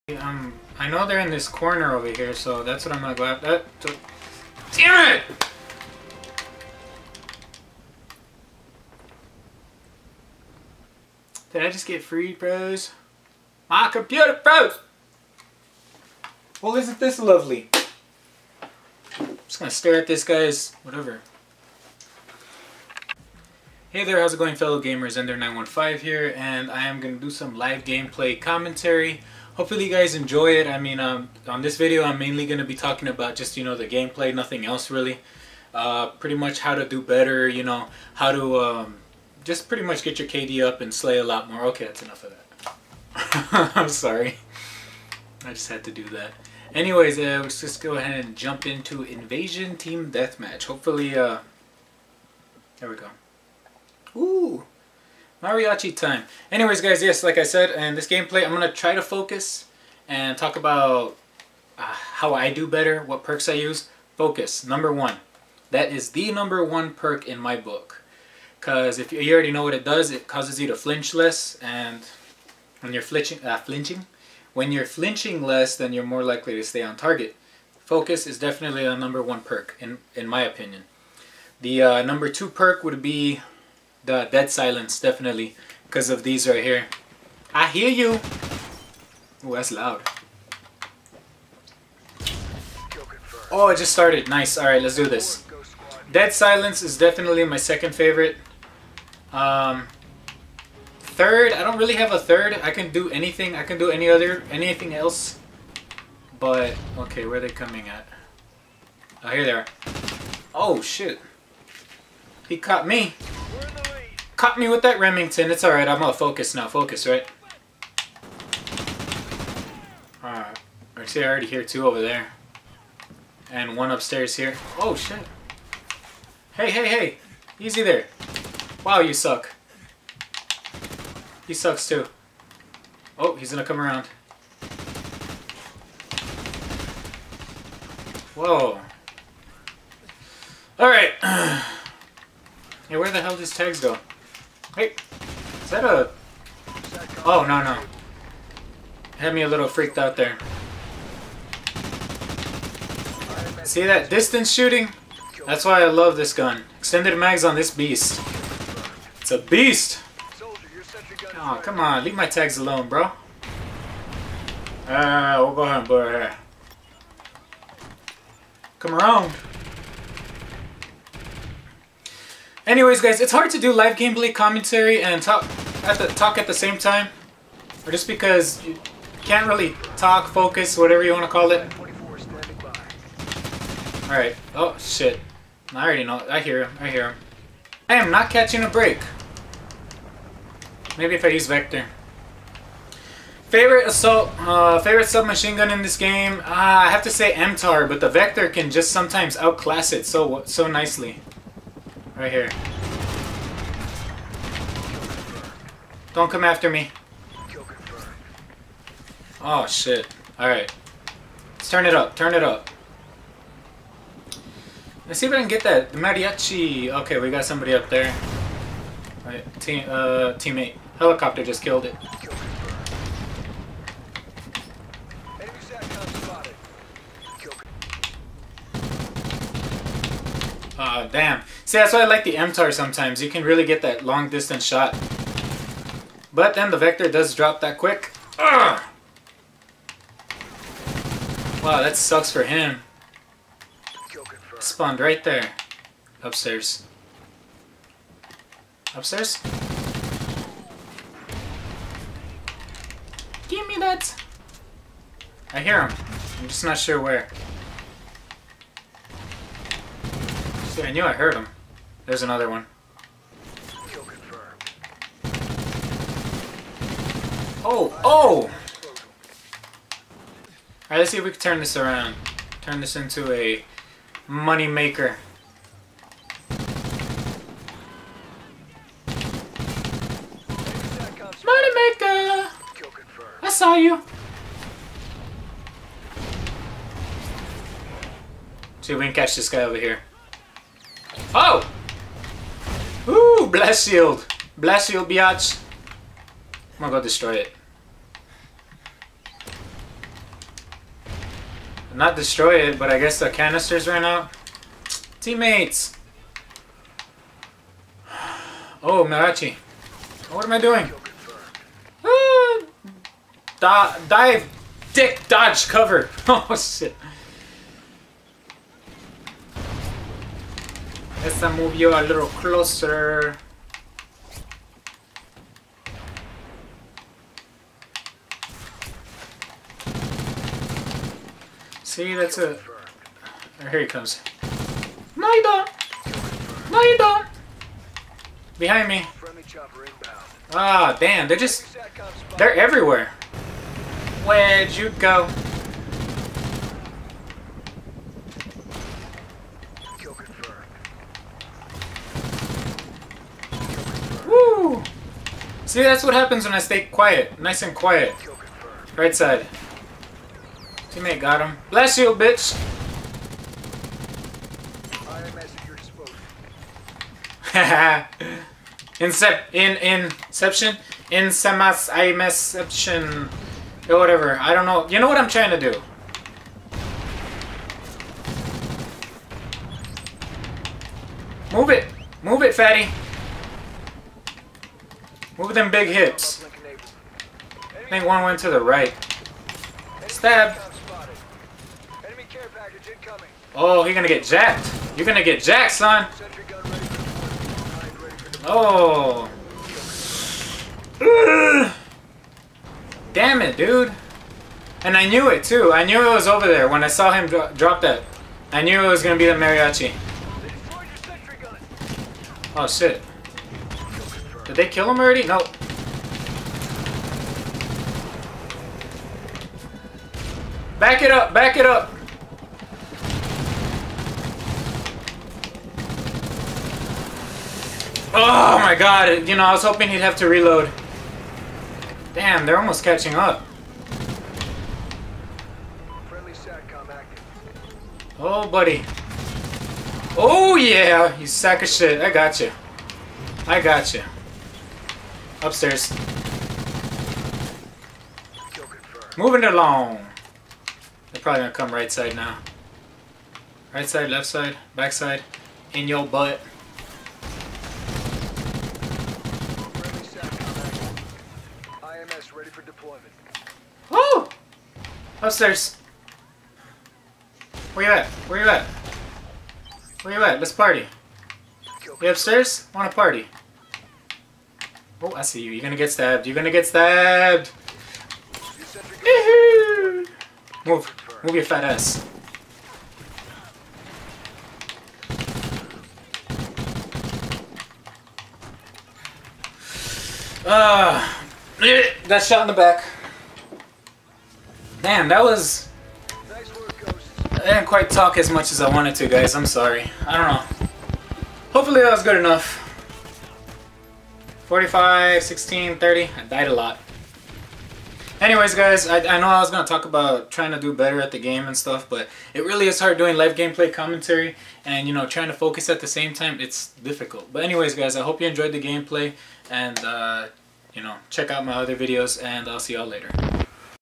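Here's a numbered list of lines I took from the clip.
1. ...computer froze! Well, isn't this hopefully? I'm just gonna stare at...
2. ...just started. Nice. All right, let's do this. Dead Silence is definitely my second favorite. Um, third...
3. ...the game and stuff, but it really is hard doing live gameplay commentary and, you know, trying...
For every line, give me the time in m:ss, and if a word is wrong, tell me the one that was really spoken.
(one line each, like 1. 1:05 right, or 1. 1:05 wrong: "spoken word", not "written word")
1. 0:13 wrong: "lovely", not "hopefully"
2. 1:33 right
3. 8:31 right.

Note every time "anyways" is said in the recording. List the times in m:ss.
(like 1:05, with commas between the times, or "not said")
0:46, 0:56, 2:52, 8:28, 8:37.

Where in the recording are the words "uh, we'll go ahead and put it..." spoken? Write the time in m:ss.
2:44.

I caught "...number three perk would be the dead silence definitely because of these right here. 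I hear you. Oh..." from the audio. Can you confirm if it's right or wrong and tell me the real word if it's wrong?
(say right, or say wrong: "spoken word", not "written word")
wrong: "two", not "three".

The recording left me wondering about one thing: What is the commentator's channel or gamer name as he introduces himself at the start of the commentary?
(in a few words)
Ender915.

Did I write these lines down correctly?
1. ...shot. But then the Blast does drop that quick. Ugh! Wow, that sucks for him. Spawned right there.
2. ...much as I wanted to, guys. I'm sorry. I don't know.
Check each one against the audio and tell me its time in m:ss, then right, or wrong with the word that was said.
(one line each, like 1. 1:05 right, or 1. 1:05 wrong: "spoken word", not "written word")
1. 3:54 wrong: "Vector", not "Blast"
2. 8:18 right.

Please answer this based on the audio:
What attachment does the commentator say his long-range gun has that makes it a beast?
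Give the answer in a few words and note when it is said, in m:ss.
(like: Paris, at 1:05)
Extended mags, at 2:36.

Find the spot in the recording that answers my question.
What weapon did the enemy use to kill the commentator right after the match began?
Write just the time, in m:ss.
1:54.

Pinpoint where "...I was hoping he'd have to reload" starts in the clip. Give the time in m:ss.
7:09.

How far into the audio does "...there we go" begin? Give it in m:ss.
0:52.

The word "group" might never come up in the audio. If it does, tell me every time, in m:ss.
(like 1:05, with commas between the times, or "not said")
not said.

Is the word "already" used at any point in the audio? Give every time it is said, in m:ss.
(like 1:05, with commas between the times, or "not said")
1:09, 2:01, 3:05, 6:54.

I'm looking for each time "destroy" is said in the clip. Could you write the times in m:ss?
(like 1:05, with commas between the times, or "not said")
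4:57, 5:02.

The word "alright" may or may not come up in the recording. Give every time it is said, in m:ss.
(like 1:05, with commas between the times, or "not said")
1:55, 2:00, 2:20, 3:30, 4:28.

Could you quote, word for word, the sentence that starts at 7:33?
Right side, left side, back side, in your butt.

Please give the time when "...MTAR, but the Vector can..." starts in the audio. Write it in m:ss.
3:17.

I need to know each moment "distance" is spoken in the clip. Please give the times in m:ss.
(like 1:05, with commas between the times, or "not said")
2:34, 3:54.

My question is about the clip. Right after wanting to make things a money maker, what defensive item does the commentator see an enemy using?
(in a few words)
Blast Shield.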